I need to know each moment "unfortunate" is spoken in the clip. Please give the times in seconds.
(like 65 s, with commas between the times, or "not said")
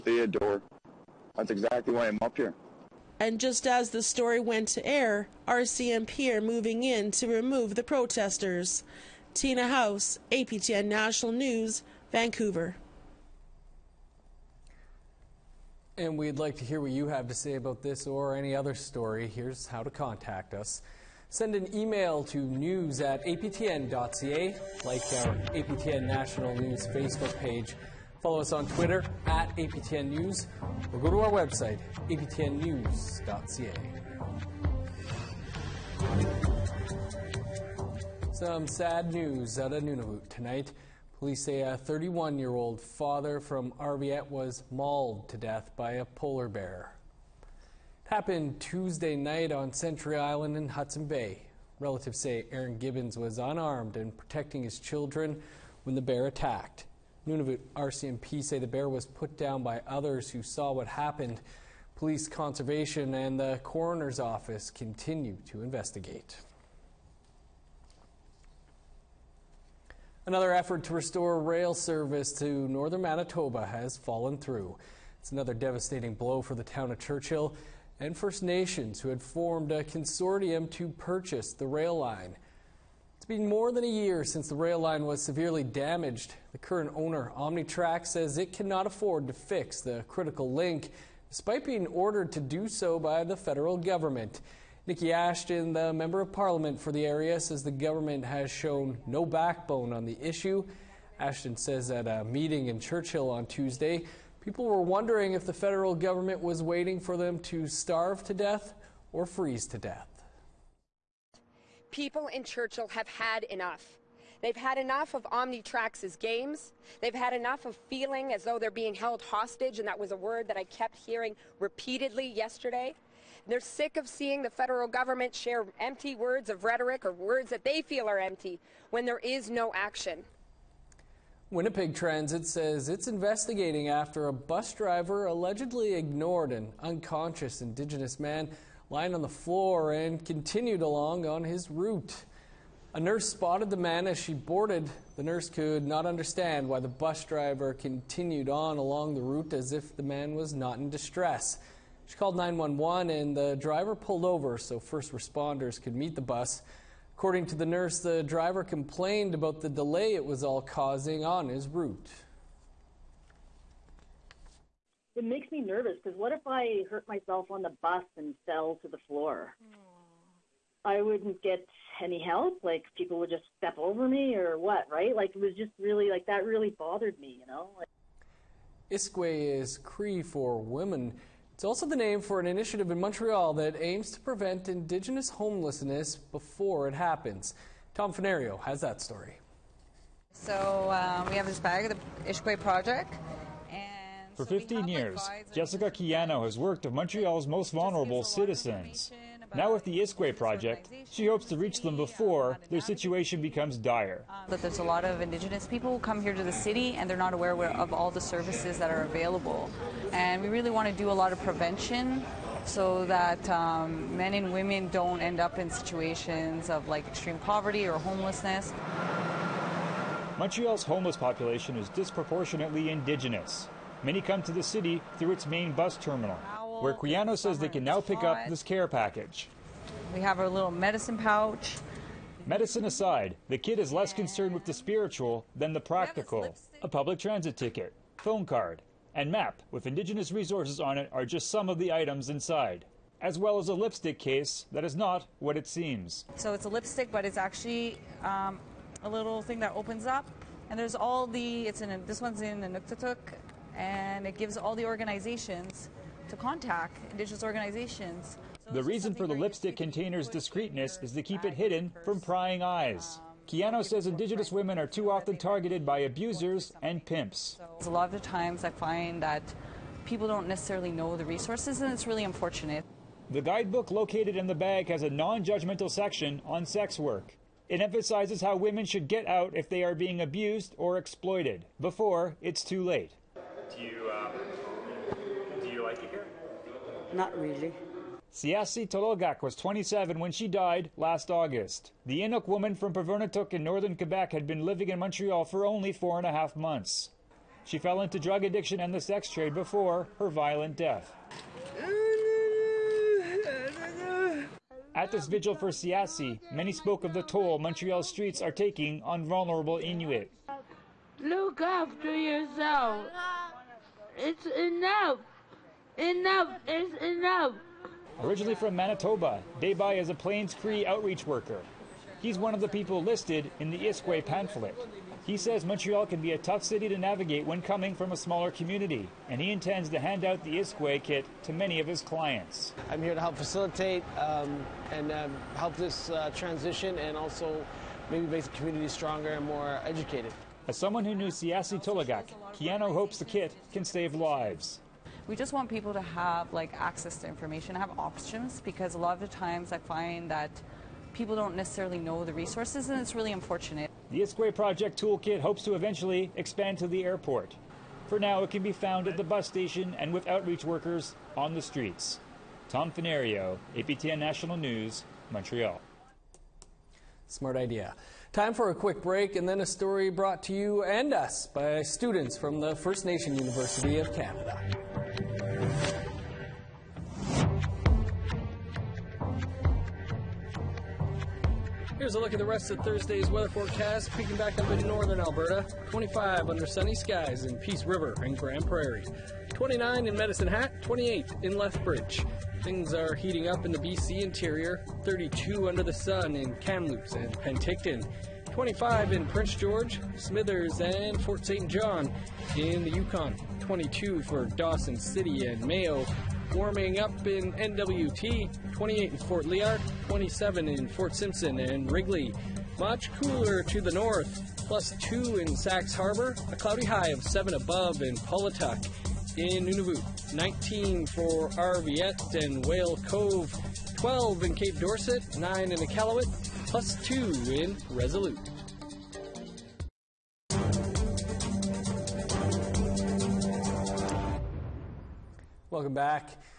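272 s, 353 s.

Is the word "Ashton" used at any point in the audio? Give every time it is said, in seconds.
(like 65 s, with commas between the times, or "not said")
95 s, 101 s.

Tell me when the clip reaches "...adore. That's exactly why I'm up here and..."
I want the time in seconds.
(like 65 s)
0 s.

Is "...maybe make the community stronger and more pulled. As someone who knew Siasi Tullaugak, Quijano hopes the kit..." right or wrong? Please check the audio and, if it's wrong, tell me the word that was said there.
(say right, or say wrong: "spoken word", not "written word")
wrong: "educated", not "pulled".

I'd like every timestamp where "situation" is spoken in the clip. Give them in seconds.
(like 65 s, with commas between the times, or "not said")
202 s, 215 s.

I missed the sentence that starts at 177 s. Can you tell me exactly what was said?
Like, Iskwe is Cree for women.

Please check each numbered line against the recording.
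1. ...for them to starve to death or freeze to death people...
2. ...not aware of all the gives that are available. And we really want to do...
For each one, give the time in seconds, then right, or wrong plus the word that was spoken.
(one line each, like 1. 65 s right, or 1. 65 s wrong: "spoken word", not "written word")
1. 106 s right
2. 207 s wrong: "services", not "gives".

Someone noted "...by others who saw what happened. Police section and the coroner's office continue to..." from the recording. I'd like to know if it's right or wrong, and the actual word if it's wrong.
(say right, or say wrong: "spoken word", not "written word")
wrong: "conservation", not "section".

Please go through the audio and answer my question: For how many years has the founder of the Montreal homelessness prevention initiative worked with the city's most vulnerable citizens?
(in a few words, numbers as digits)
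15.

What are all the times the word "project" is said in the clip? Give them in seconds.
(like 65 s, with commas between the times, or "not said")
192 s, 200 s, 354 s.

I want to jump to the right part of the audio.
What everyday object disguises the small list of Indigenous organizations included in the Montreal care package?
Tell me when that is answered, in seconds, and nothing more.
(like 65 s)
243 s.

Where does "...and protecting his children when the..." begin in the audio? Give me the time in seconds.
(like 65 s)
53 s.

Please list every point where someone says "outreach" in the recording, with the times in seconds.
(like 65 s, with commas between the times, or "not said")
320 s, 360 s.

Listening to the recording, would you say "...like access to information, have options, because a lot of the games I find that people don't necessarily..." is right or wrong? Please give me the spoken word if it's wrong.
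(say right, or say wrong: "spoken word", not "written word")
wrong: "times", not "games".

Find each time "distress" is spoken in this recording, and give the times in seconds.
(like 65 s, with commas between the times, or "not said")
150 s.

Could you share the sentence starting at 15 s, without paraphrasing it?
And we'd like to hear what you have to say about this or any other story.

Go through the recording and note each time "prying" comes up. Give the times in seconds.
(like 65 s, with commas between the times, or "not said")
262 s.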